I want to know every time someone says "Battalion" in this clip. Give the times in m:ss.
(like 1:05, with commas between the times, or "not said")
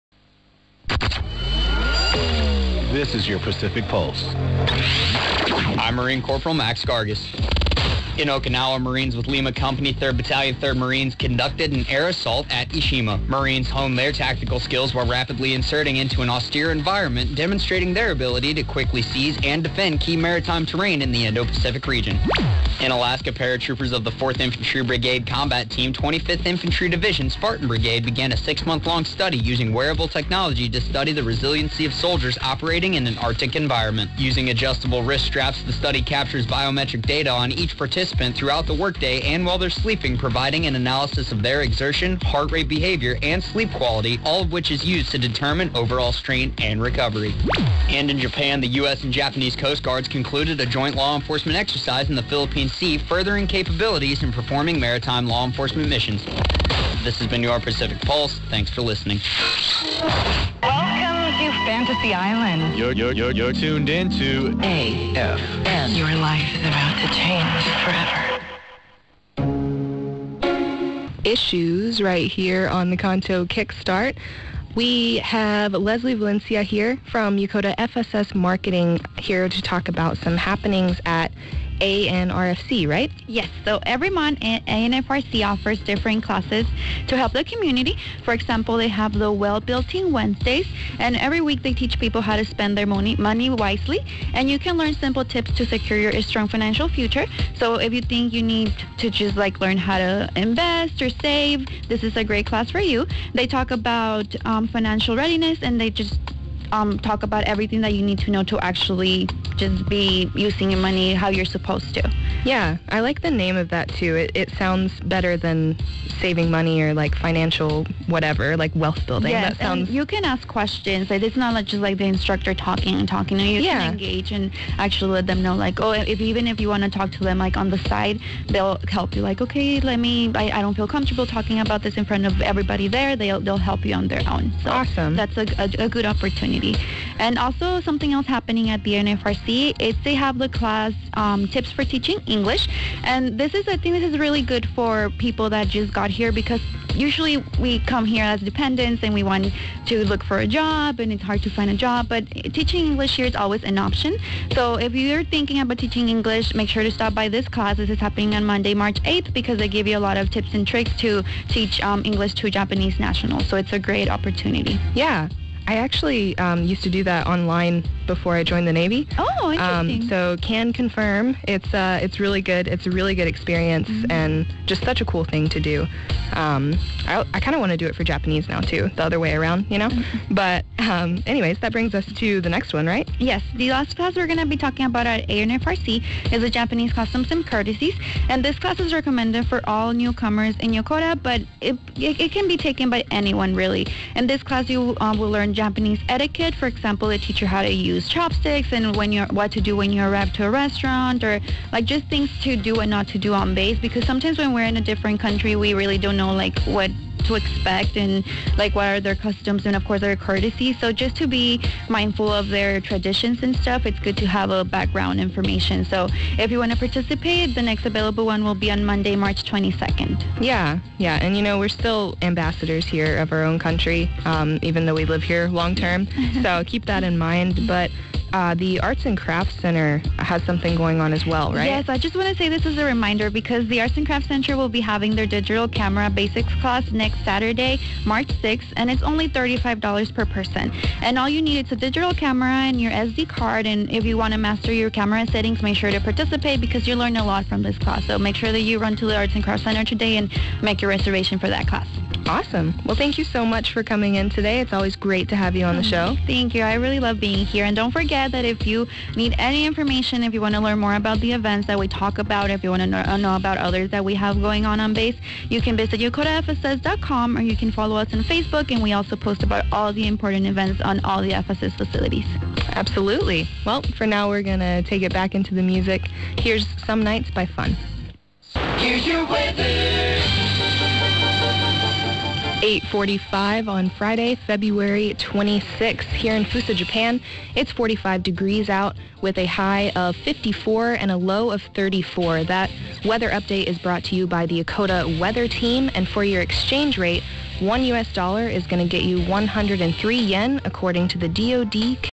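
0:10.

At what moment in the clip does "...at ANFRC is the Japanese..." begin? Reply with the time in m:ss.
3:05.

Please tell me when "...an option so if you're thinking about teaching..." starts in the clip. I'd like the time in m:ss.
2:33.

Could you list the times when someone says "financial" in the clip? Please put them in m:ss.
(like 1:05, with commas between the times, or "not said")
1:36, 1:44, 1:57.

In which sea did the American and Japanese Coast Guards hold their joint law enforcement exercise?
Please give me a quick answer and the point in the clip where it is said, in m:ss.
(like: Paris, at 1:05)
Philippine Sea, at 0:52.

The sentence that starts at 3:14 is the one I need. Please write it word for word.
In this class, you uh, will learn Japanese etiquette.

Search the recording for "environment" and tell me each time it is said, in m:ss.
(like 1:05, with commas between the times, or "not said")
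0:16, 0:33.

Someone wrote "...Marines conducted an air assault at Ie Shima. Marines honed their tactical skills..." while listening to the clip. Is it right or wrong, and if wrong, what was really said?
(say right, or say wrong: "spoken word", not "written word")
right.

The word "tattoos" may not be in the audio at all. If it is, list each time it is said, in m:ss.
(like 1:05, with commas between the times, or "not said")
not said.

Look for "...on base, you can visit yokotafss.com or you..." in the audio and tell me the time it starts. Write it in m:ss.
4:24.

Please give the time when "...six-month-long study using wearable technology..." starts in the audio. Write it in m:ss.
0:28.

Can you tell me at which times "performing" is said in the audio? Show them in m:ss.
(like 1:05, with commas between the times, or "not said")
0:54.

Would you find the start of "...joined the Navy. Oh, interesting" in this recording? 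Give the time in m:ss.
2:48.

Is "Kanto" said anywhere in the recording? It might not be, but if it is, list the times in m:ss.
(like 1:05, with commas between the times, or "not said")
1:12.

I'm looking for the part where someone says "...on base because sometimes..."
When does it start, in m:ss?
3:23.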